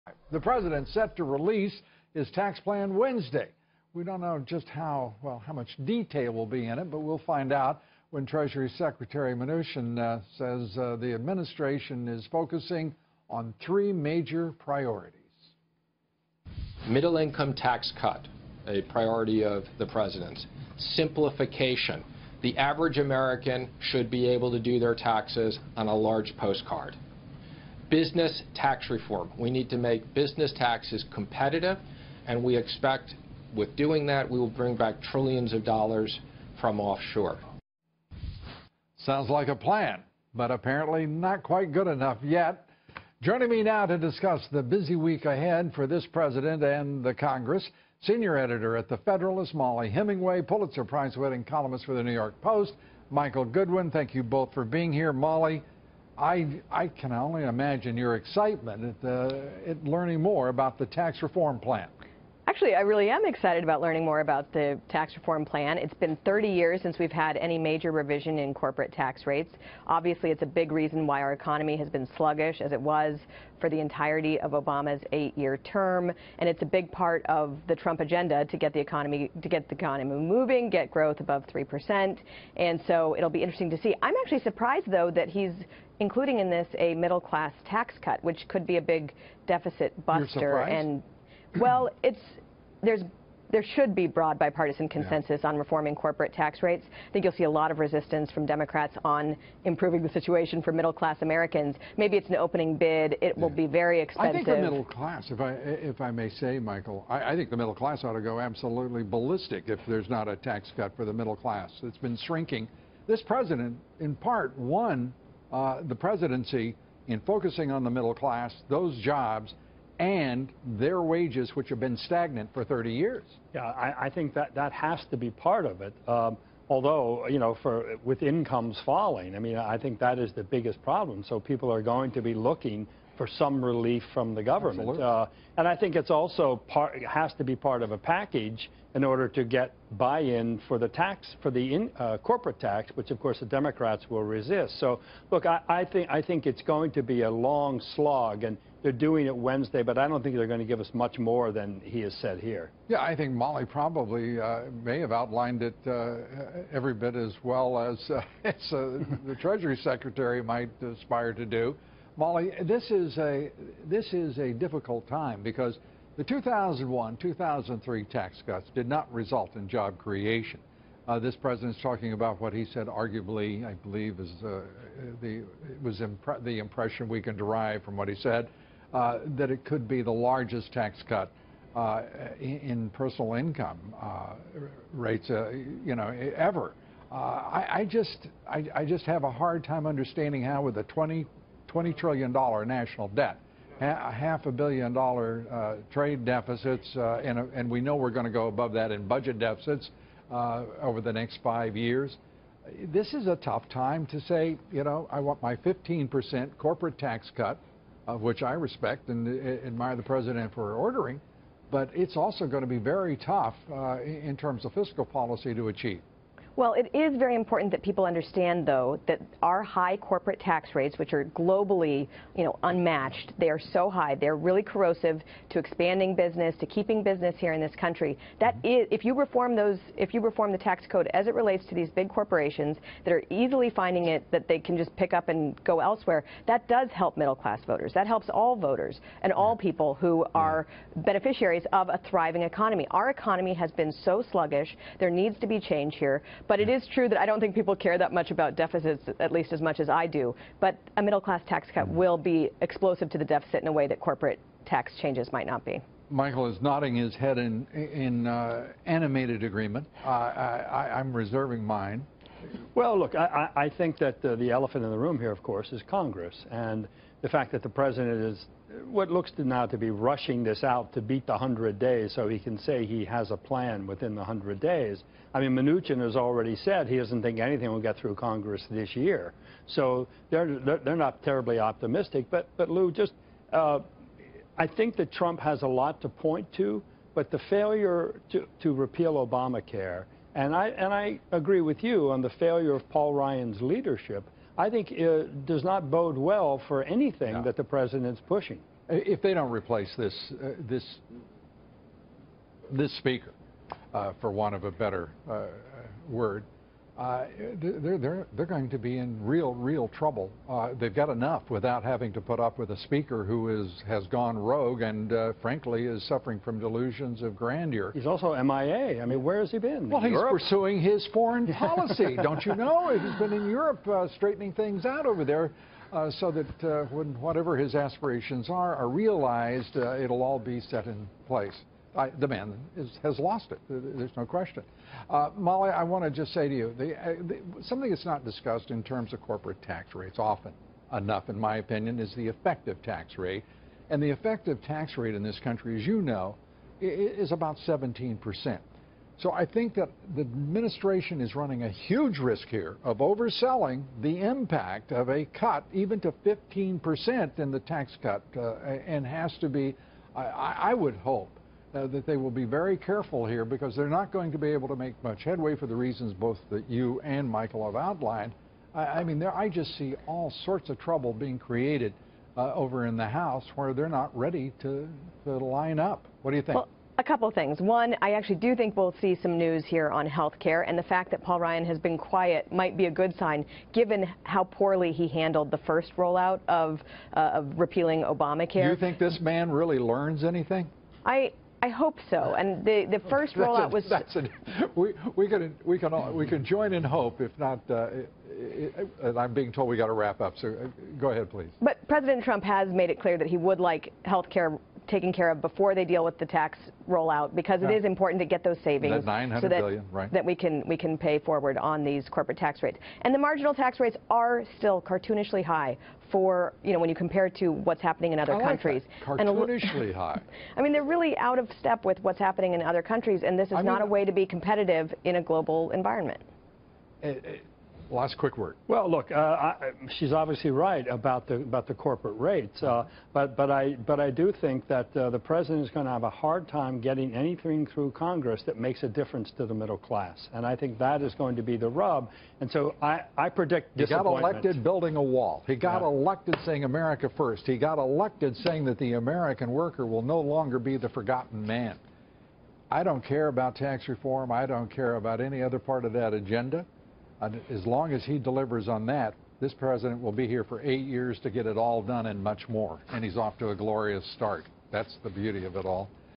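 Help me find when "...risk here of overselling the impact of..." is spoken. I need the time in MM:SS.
05:52.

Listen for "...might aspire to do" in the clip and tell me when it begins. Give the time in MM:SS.
02:40.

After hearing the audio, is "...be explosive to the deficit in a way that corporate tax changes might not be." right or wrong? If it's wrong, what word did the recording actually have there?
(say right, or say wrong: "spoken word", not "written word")
right.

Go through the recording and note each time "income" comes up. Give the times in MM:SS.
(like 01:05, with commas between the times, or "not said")
00:17, 02:08, 03:03.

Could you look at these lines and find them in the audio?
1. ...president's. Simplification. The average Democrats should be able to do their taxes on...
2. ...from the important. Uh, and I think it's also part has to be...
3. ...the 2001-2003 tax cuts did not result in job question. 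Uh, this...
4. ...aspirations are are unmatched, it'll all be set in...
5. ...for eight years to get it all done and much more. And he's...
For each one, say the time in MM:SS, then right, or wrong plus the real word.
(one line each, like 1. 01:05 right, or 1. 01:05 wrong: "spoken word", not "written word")
1. 00:19 wrong: "American", not "Democrats"
2. 02:14 wrong: "government", not "important"
3. 02:46 wrong: "creation", not "question"
4. 05:27 wrong: "realized", not "unmatched"
5. 07:40 right.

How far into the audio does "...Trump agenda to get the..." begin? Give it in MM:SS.
01:17.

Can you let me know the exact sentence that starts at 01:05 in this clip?
It's been 30 years since we've had any major revision in corporate tax rates.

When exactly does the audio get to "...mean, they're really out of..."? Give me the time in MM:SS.
07:00.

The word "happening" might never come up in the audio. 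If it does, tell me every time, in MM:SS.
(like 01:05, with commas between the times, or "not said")
06:57, 07:02.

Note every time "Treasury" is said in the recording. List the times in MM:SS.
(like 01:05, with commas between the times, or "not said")
00:08, 02:39.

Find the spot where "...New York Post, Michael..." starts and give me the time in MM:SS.
00:52.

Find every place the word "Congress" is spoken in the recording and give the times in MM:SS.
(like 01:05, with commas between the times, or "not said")
00:47, 04:25, 04:38, 07:17.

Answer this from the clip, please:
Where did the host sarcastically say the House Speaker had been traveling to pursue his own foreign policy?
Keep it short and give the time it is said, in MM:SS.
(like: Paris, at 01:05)
Europe, at 05:23.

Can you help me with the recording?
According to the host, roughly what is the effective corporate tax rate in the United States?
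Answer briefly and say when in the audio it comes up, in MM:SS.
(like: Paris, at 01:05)
17%, at 05:47.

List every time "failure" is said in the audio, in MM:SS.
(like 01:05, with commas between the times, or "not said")
04:47, 04:52.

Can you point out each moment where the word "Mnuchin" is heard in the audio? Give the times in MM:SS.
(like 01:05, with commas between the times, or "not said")
00:09, 04:35.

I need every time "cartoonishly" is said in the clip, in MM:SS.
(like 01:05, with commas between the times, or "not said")
06:54, 06:59.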